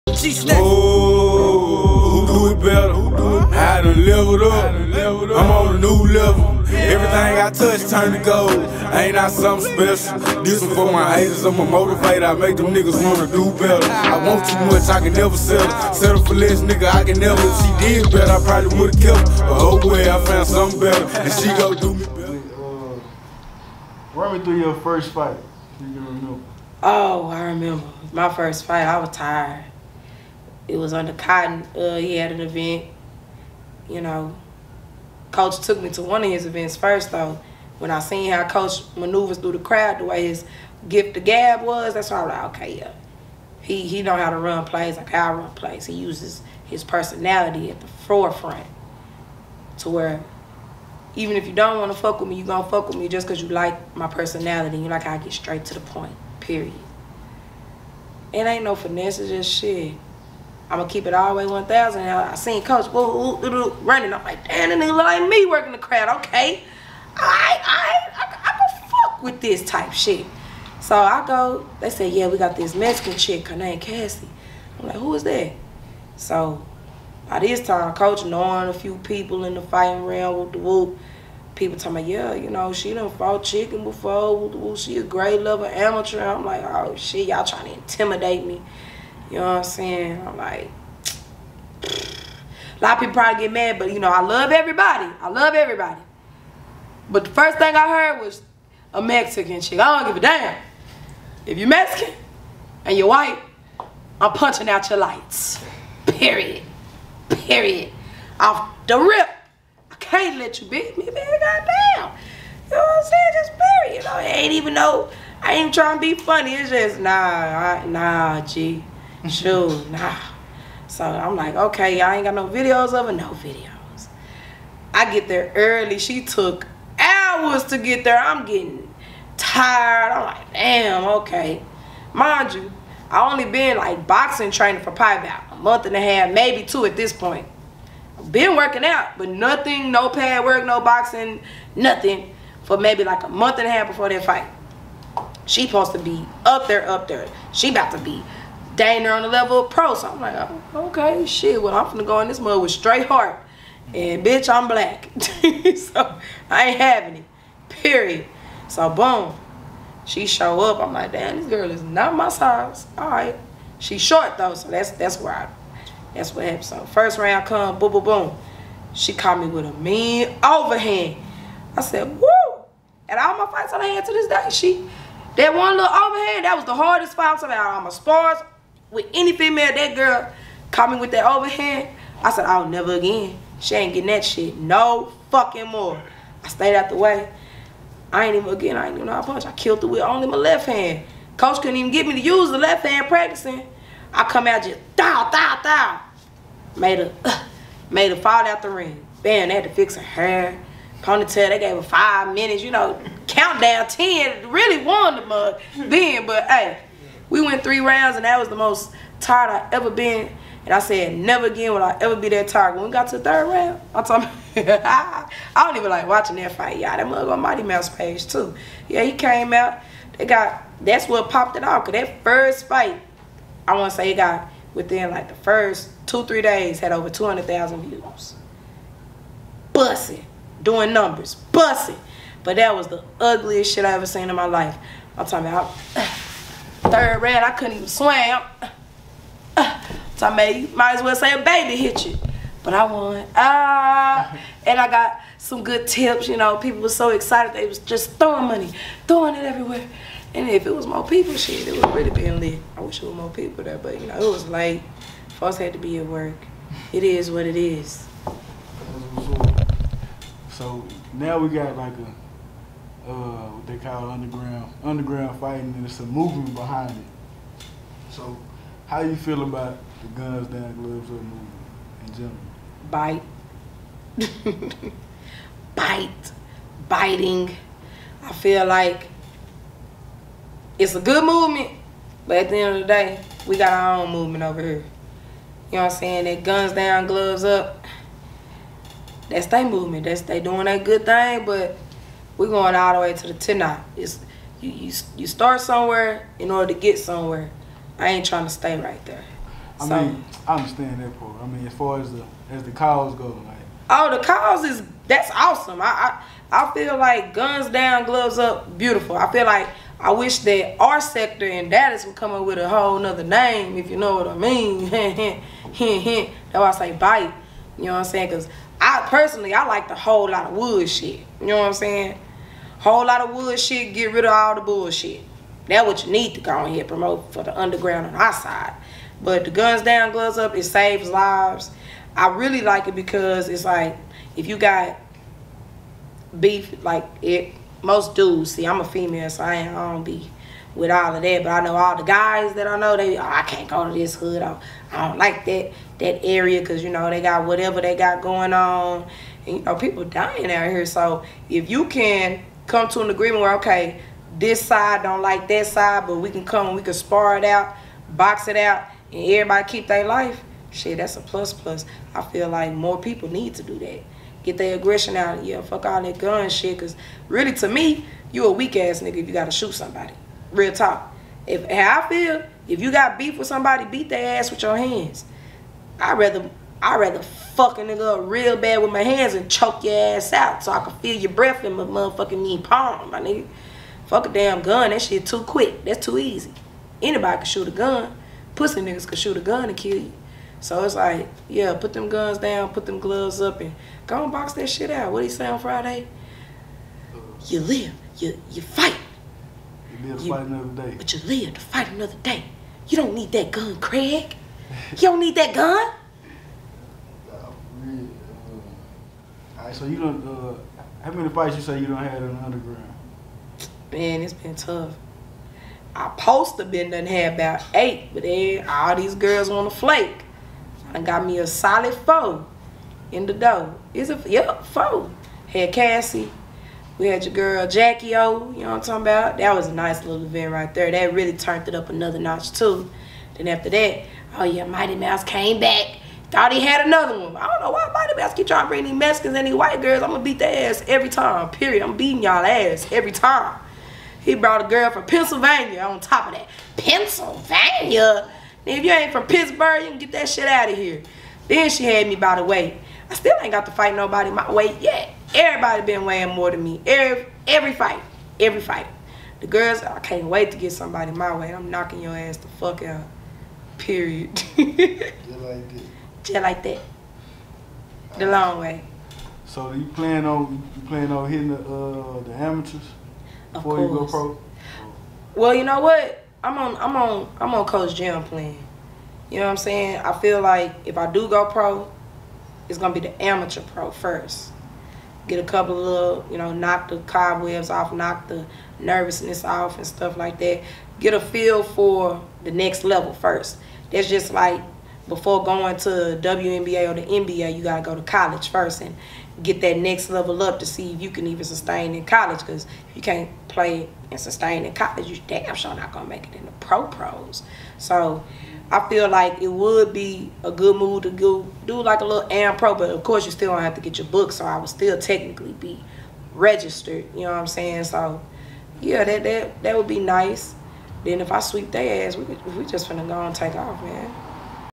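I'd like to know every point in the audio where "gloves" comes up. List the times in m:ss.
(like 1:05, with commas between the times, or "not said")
4:30, 4:47, 5:08, 5:30, 6:32.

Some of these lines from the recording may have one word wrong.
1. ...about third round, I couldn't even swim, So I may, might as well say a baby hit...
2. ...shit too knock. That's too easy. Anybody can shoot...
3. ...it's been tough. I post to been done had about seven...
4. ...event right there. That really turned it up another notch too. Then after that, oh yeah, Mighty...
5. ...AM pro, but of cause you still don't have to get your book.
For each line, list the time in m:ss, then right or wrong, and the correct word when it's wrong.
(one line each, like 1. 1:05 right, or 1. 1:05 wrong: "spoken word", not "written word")
1. 3:55 right
2. 6:25 wrong: "quick", not "knock"
3. 6:54 wrong: "eight", not "seven"
4. 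7:10 right
5. 8:32 wrong: "course", not "cause".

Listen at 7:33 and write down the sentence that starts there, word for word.
I still ain't got to fight nobody my weight yet.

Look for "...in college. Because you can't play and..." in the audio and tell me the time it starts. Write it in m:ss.
8:21.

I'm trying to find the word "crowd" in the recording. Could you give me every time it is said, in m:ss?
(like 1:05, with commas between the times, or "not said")
0:39, 1:05.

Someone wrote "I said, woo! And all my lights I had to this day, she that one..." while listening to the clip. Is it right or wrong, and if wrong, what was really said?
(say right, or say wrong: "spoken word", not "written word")
wrong: "fights", not "lights".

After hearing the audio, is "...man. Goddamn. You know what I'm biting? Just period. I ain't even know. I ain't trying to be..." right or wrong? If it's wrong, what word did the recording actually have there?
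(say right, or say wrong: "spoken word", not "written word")
wrong: "saying", not "biting".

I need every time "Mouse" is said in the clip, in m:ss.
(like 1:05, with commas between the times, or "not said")
3:37, 7:14.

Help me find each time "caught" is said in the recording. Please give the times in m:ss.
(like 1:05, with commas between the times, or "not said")
2:49, 3:00.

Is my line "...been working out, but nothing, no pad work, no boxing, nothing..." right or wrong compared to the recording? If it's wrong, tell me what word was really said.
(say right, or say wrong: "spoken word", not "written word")
right.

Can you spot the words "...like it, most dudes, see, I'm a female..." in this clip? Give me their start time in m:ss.
5:36.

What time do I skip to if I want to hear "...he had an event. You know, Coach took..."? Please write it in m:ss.
0:31.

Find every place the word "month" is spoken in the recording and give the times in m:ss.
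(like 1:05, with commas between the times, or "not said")
2:15, 2:23.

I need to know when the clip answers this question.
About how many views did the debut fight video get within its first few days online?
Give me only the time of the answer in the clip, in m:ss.
3:47.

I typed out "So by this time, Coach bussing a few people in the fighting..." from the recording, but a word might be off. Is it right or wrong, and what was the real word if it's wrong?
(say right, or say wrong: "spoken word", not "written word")
wrong: "knowing", not "bussing".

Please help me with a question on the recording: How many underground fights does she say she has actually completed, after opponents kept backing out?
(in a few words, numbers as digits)
4.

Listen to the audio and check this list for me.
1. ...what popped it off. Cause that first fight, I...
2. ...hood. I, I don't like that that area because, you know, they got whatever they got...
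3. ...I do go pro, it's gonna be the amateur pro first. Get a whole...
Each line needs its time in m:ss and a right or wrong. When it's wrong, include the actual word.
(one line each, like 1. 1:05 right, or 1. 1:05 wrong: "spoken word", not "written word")
1. 3:41 right
2. 5:44 right
3. 8:00 wrong: "couple", not "whole".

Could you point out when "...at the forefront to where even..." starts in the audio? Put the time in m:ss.
0:47.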